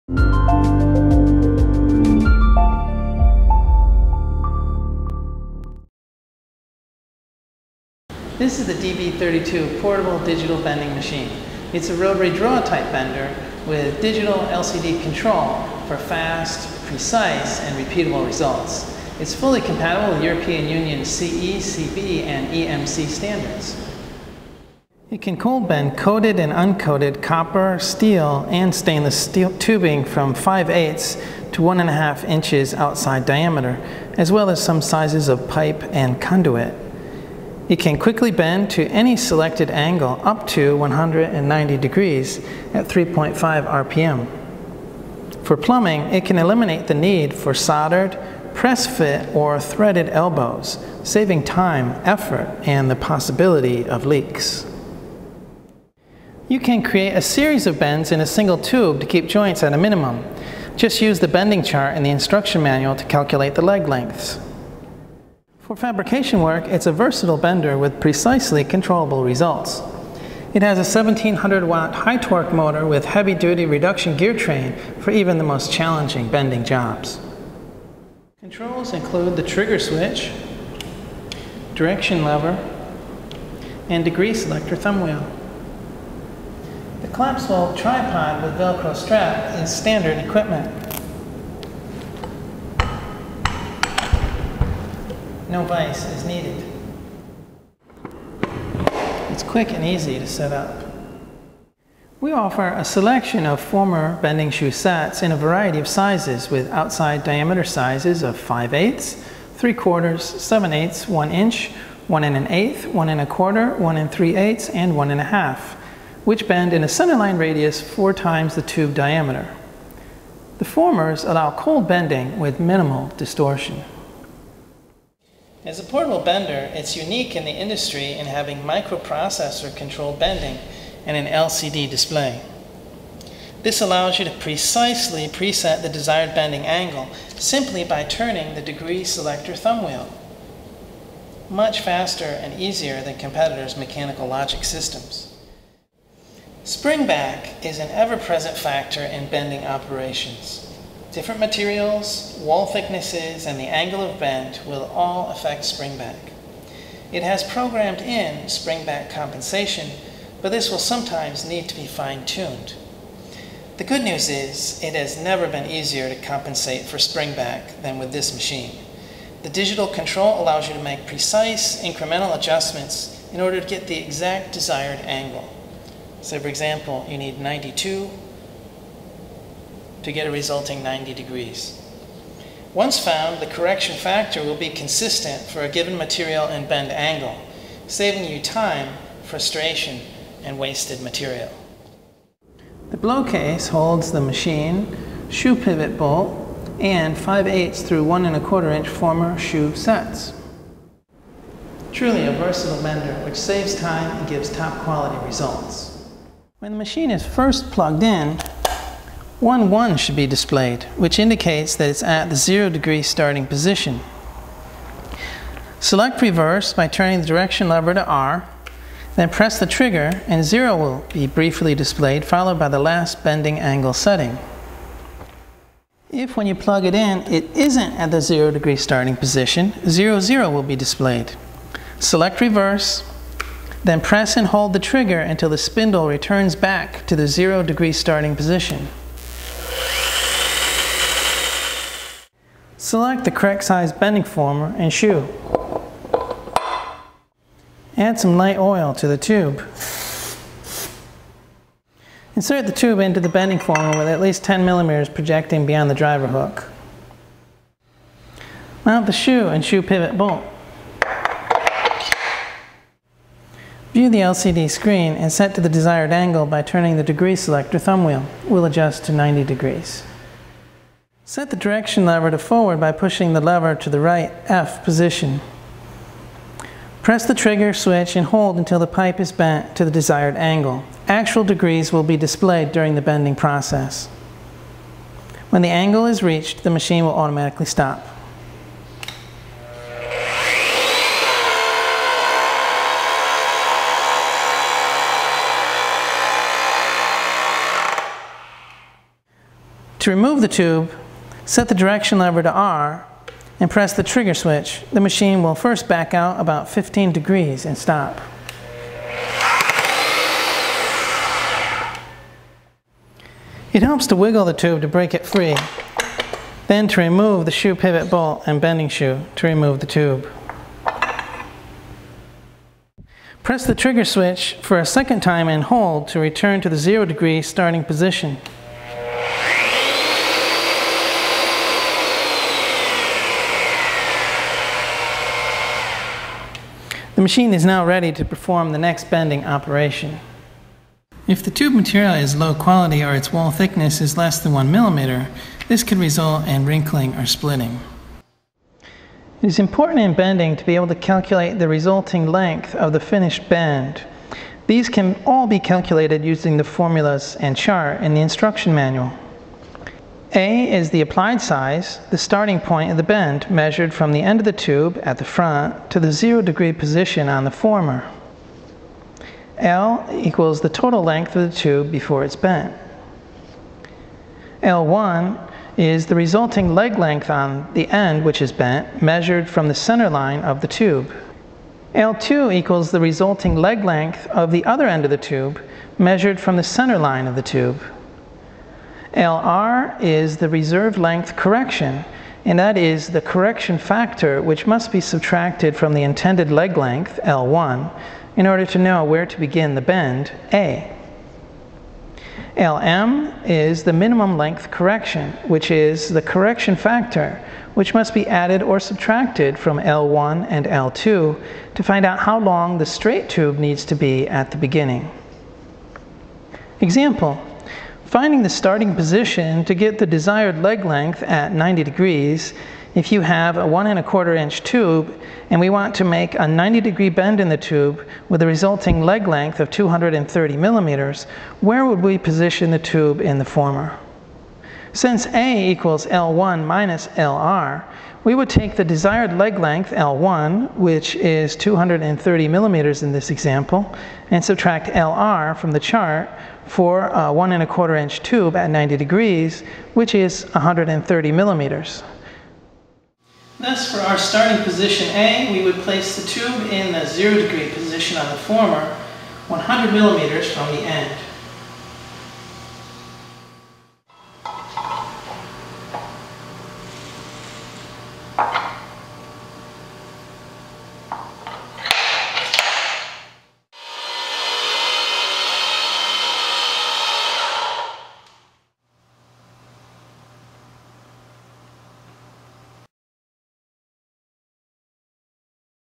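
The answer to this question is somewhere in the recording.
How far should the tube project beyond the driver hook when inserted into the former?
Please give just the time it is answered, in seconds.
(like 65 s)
254 s.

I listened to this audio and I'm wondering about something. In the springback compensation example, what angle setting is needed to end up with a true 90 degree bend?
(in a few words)
92.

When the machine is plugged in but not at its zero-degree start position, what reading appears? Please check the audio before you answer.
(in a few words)
0, 0.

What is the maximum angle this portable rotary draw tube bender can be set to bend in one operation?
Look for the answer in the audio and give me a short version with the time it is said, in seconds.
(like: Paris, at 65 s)
190 degrees, at 40 s.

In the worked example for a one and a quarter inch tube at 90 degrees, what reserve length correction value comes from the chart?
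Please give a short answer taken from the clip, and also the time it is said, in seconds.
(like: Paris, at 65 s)
130 millimeters, at 450 s.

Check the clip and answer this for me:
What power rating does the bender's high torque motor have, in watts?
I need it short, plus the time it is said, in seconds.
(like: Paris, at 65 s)
1700 watts, at 70 s.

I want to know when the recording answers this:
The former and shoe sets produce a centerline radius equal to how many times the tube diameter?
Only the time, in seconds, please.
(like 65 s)
117 s.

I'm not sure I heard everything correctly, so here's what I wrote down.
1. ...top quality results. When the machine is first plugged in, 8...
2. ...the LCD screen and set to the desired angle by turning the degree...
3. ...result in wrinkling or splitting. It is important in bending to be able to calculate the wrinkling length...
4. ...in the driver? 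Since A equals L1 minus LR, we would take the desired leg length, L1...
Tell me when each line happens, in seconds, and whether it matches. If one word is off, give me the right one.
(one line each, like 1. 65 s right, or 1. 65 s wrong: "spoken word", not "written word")
1. 204 s wrong: "1", not "8"
2. 264 s right
3. 345 s wrong: "resulting", not "wrinkling"
4. 433 s wrong: "former", not "driver".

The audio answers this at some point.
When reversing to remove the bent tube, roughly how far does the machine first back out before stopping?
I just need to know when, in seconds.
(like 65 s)
306 s.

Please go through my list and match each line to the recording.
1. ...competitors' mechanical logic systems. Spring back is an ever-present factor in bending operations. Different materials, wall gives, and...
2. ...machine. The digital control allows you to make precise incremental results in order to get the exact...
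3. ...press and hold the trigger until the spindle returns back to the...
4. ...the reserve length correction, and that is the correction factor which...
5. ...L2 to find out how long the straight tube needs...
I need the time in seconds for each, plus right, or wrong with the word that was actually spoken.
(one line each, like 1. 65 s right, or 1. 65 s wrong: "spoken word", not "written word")
1. 143 s wrong: "thicknesses", not "gives"
2. 168 s wrong: "adjustments", not "results"
3. 234 s right
4. 390 s right
5. 410 s right.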